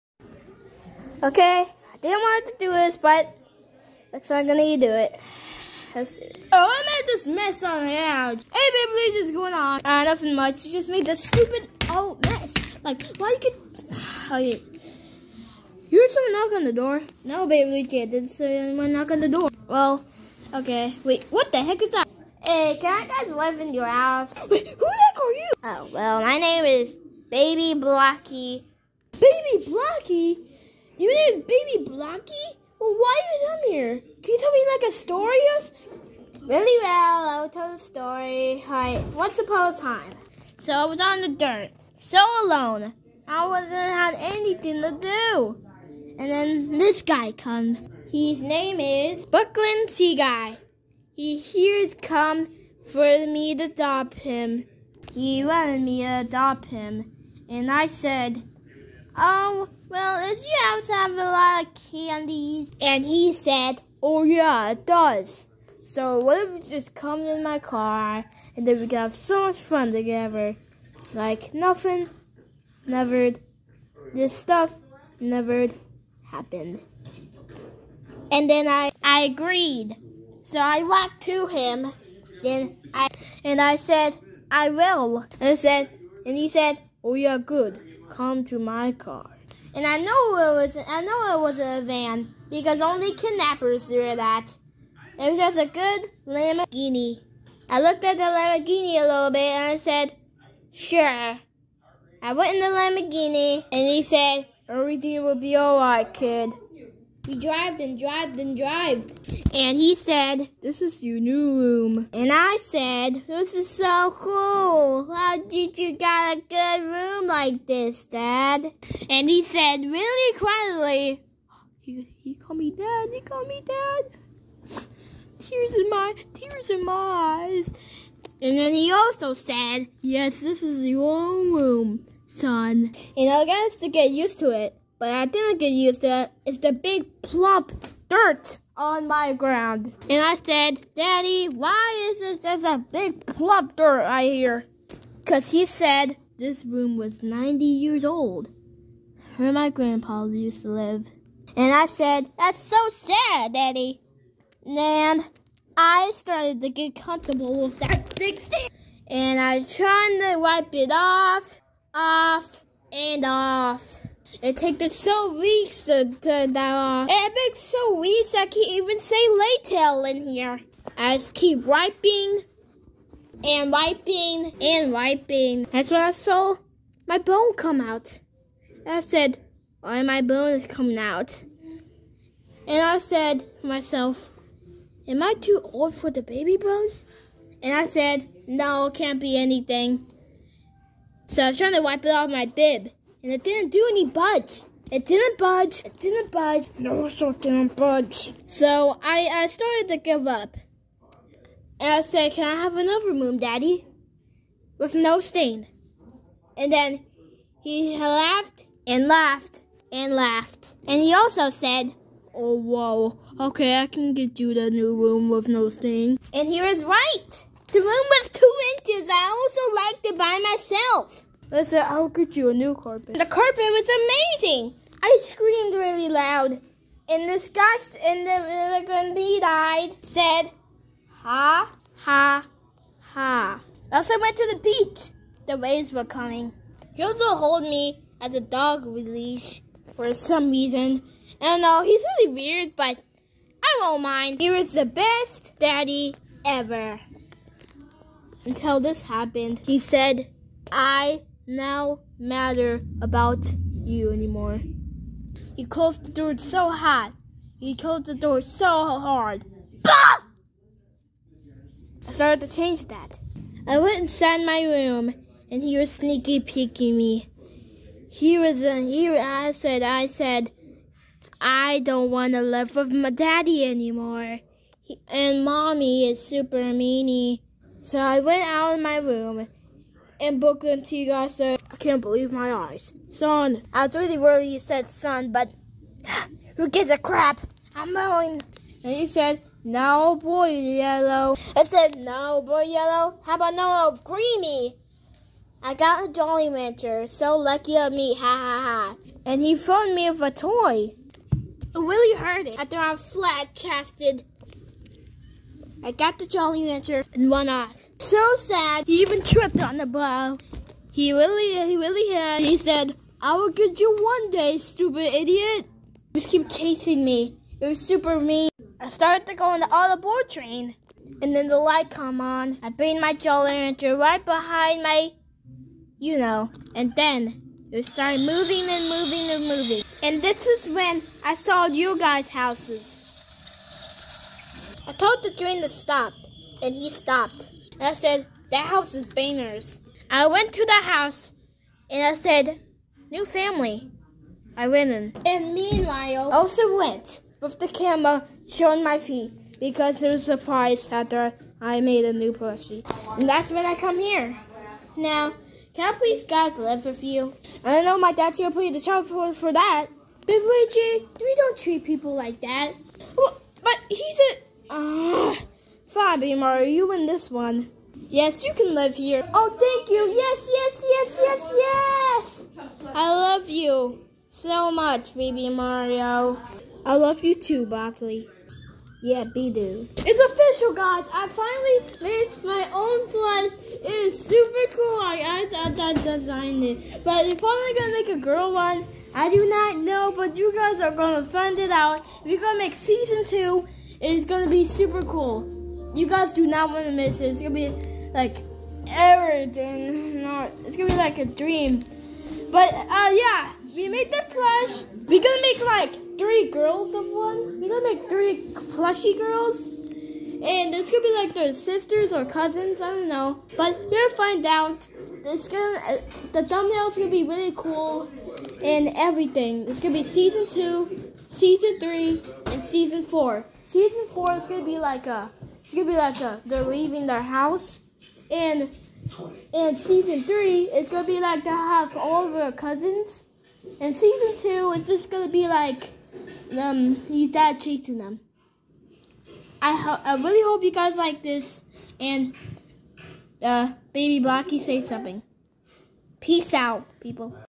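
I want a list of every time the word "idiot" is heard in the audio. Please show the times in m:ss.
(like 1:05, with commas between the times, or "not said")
5:15.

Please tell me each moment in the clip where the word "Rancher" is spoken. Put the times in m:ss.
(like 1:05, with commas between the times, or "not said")
4:56, 5:06, 5:23.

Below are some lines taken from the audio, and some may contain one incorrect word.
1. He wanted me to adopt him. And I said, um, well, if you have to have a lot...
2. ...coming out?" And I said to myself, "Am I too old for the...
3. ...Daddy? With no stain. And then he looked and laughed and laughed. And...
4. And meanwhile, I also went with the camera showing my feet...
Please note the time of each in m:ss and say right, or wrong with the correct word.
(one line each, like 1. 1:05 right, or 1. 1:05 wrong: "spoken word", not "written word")
1. 0:55 right
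2. 3:00 right
3. 3:23 wrong: "laughed", not "looked"
4. 5:45 right.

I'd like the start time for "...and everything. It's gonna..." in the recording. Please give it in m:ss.
6:58.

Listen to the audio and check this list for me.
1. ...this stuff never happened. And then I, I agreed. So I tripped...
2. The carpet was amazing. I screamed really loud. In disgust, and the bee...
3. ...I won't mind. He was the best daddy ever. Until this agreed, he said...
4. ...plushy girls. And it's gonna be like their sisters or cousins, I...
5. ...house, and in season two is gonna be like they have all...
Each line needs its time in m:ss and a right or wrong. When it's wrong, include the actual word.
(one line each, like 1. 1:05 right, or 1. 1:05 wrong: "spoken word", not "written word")
1. 1:14 wrong: "walked", not "tripped"
2. 3:43 right
3. 4:03 wrong: "happened", not "agreed"
4. 6:48 right
5. 7:07 wrong: "three", not "two".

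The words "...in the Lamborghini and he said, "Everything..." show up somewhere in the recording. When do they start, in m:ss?
1:42.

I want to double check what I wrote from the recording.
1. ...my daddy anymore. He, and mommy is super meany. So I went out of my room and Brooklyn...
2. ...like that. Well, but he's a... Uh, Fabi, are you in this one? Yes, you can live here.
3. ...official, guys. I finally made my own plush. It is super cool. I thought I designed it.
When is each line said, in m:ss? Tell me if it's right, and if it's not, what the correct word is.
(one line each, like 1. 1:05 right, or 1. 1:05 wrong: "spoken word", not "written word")
1. 4:32 right
2. 6:02 right
3. 6:20 right.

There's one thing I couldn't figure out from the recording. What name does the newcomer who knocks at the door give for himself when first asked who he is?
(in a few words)
Baby Blackie.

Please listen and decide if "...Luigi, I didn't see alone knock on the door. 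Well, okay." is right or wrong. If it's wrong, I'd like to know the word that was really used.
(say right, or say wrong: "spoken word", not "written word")
wrong: "anyone", not "alone".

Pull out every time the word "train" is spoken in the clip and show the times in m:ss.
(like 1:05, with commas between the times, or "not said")
5:20, 5:35.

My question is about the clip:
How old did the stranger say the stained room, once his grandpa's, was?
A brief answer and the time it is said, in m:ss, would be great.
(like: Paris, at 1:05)
90 years, at 2:27.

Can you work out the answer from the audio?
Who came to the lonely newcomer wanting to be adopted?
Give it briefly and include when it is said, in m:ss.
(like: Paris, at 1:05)
Brooklyn Sea Guy, at 0:49.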